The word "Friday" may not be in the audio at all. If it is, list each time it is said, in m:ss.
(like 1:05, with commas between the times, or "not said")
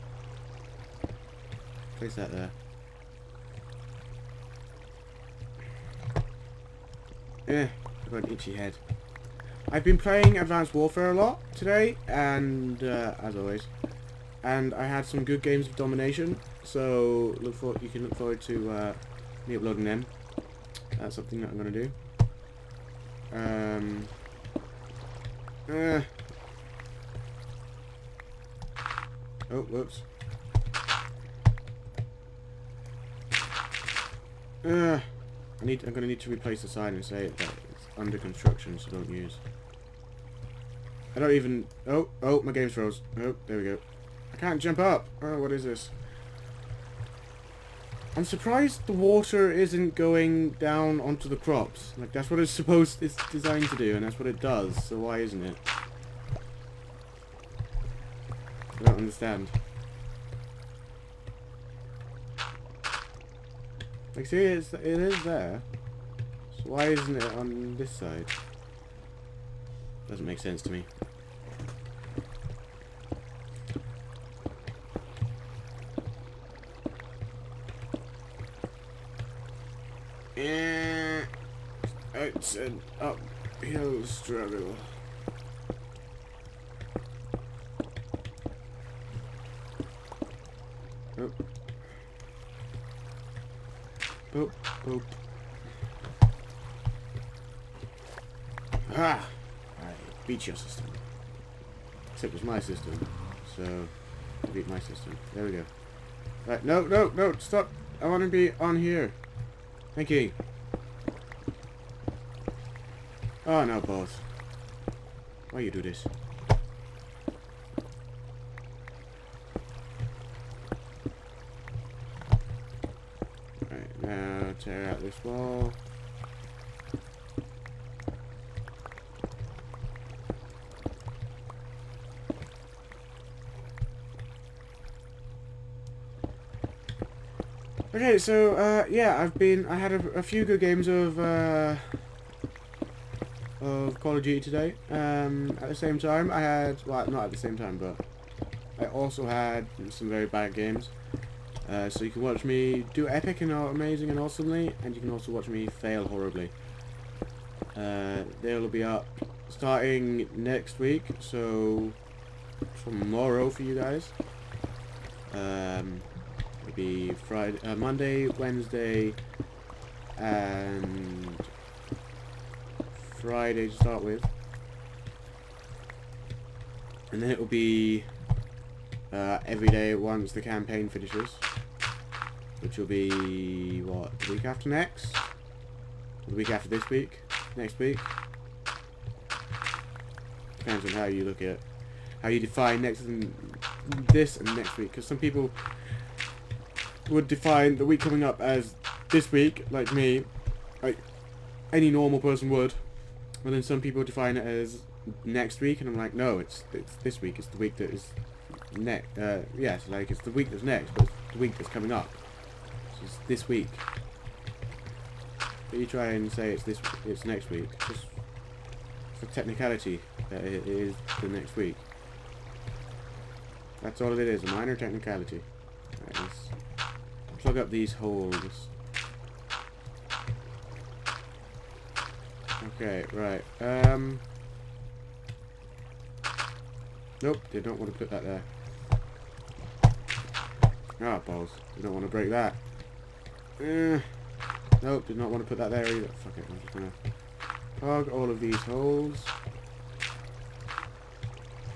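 2:47, 2:53.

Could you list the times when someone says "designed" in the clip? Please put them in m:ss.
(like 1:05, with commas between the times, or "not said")
0:53.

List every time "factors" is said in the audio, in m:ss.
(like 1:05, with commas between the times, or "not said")
not said.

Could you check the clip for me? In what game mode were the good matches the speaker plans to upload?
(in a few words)
Domination.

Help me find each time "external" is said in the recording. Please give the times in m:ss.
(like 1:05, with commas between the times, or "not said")
not said.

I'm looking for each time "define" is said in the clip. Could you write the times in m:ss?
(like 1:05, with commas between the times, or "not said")
3:12, 3:17, 3:24.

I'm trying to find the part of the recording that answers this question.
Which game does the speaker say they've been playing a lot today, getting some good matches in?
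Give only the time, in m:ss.
0:10.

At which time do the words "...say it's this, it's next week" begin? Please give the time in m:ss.
3:36.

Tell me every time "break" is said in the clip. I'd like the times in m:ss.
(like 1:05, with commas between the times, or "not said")
4:02.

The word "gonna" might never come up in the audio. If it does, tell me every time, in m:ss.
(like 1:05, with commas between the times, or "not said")
0:21, 0:35, 4:06.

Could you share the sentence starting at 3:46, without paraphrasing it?
Right, let's plug up these holes.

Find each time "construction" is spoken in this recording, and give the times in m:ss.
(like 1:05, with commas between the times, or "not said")
0:38.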